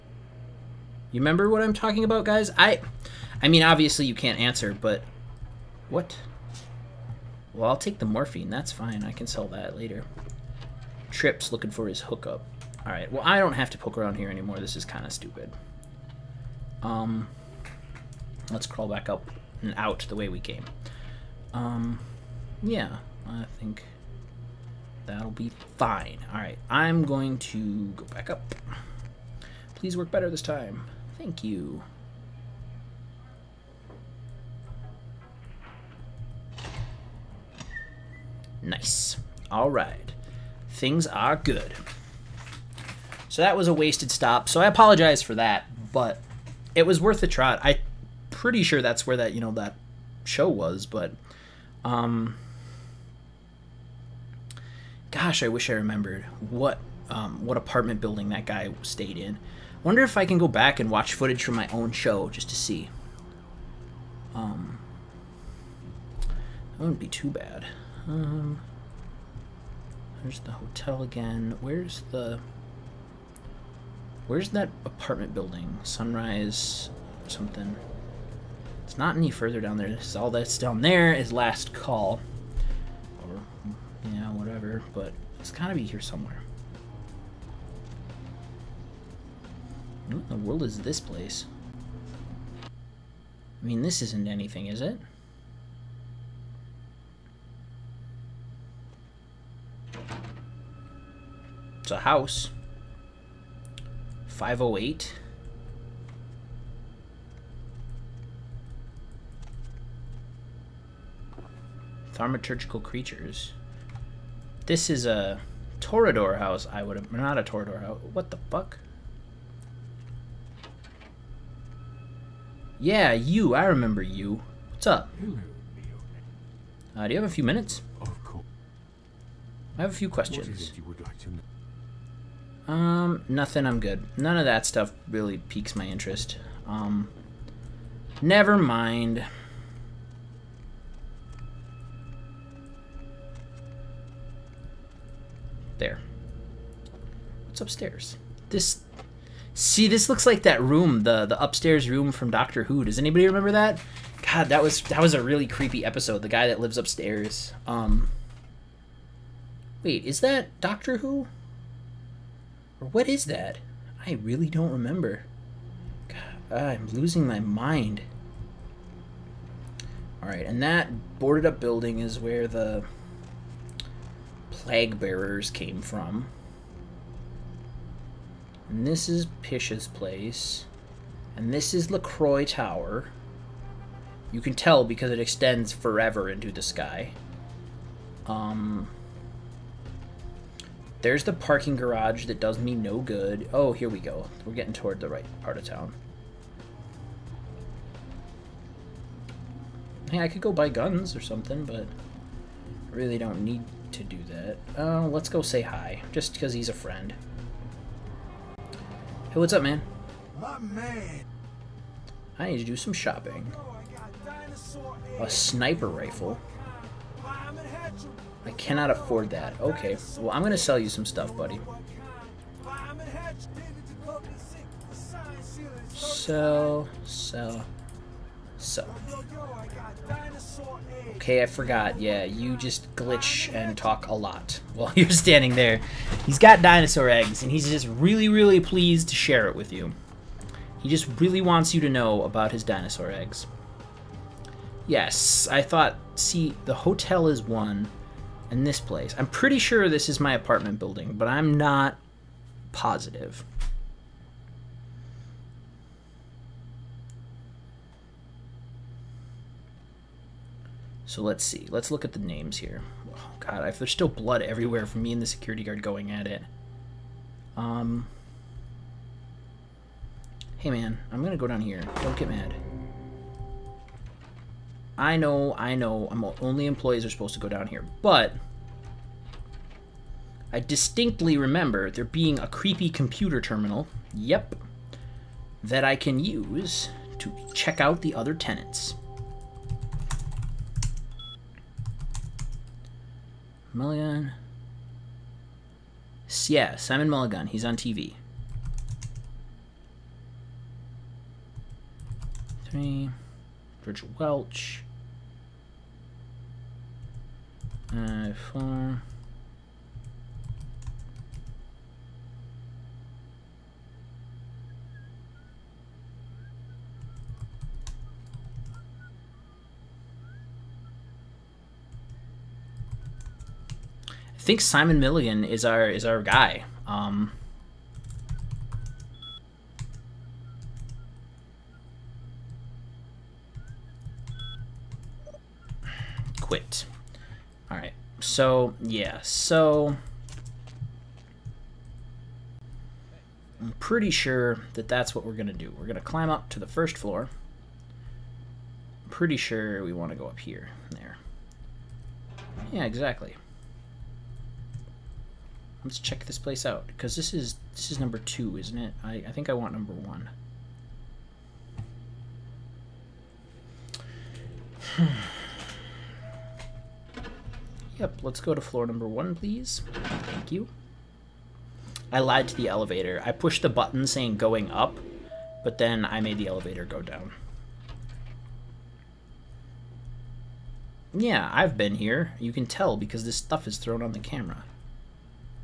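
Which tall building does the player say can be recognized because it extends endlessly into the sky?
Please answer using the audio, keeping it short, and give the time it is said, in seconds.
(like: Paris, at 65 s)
LaCroix Tower, at 181 s.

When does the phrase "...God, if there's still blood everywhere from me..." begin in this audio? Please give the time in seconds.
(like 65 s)
263 s.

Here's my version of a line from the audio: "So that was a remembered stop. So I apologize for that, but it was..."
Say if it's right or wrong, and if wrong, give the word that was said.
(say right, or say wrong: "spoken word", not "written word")
wrong: "wasted", not "remembered".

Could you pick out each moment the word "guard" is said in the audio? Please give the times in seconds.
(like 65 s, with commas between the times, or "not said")
265 s.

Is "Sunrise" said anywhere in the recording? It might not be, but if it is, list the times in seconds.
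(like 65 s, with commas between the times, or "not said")
75 s.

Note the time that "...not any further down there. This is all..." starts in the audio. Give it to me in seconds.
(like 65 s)
78 s.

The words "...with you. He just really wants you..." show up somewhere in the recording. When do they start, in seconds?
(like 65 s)
239 s.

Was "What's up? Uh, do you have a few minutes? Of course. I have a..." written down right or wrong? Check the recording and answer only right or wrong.
right.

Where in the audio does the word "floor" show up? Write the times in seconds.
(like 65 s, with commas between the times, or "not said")
346 s, 368 s.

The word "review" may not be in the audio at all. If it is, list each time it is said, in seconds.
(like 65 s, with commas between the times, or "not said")
not said.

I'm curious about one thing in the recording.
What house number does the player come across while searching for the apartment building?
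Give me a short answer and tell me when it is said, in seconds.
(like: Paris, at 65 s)
508, at 104 s.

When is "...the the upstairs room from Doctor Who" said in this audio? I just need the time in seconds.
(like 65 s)
151 s.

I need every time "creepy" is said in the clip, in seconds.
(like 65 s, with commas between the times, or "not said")
155 s, 282 s.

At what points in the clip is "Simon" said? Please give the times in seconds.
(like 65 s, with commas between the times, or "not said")
296 s, 324 s.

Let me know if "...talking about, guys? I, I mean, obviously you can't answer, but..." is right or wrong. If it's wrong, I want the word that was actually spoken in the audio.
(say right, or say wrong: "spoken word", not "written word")
right.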